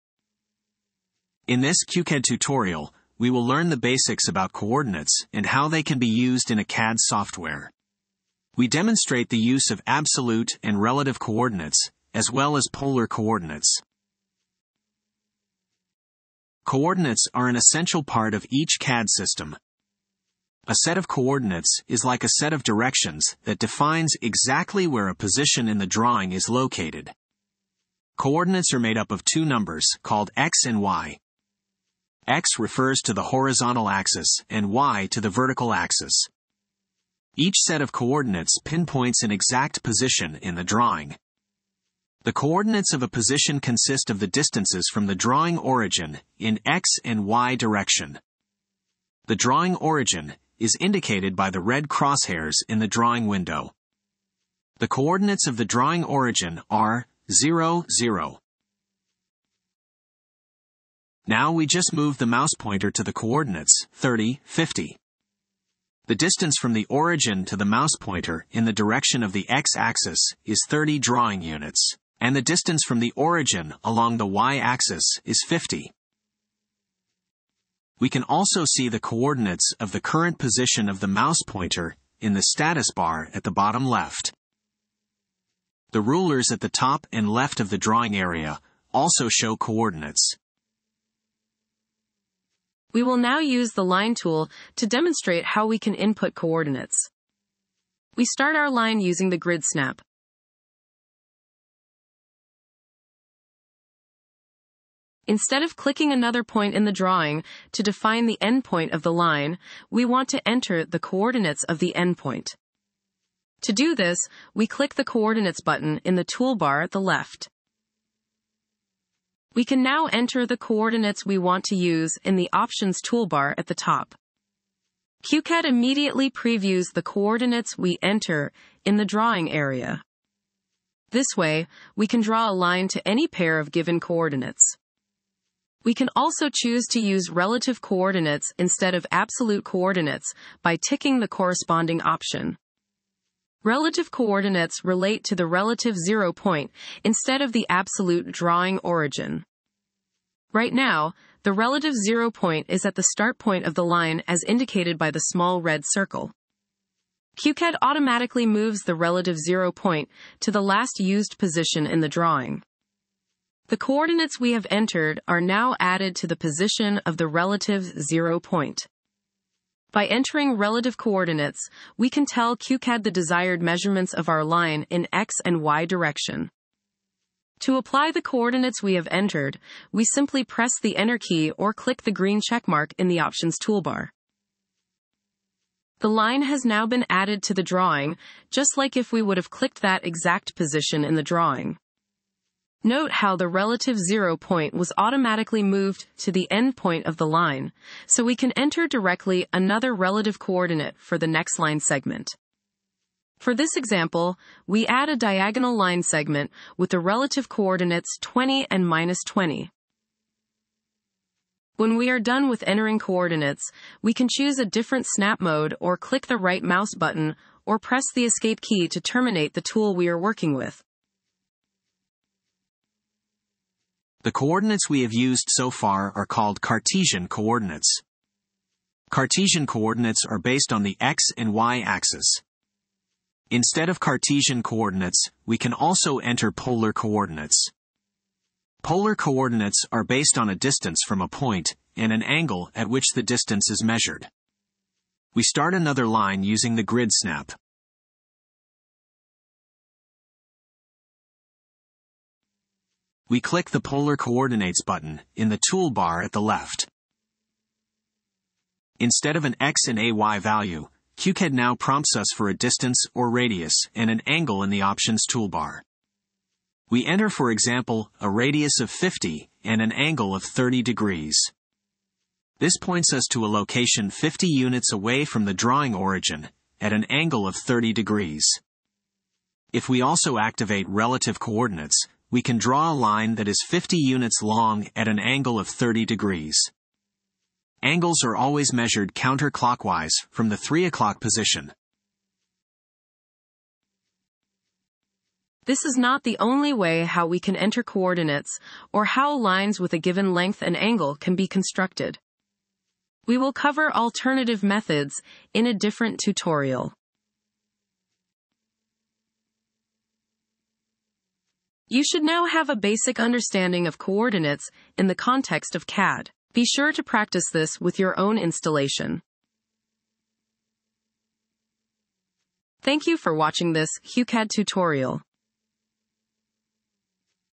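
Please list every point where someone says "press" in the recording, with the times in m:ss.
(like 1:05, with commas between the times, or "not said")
3:00, 3:37.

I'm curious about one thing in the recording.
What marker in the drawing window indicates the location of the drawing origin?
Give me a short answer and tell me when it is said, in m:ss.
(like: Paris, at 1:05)
red crosshairs, at 0:51.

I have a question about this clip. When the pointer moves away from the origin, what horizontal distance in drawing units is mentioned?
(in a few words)
30.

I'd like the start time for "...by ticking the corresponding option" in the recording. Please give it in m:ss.
2:20.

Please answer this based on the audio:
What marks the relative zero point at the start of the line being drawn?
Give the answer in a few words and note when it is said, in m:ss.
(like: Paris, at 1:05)
small red circle, at 2:35.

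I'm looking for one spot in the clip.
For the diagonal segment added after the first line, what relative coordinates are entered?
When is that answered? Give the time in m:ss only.
3:28.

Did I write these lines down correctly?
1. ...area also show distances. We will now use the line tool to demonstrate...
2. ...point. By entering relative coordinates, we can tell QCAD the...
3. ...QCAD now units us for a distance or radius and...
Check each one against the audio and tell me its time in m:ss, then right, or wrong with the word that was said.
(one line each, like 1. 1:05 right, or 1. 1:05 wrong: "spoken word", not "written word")
1. 1:28 wrong: "coordinates", not "distances"
2. 2:48 right
3. 4:21 wrong: "prompts", not "units".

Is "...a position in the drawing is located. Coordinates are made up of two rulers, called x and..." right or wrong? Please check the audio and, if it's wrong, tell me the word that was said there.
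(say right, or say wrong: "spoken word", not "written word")
wrong: "numbers", not "rulers".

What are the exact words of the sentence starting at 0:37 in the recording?
Each set of coordinates pinpoints an exact position in the drawing.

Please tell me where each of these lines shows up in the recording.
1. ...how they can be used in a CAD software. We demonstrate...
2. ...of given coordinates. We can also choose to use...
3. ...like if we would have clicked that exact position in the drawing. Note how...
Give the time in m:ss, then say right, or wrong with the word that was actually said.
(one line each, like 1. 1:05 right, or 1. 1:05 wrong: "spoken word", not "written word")
1. 0:05 right
2. 2:13 right
3. 3:08 right.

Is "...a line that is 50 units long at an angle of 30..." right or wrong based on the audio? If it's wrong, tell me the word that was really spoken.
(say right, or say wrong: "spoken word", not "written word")
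right.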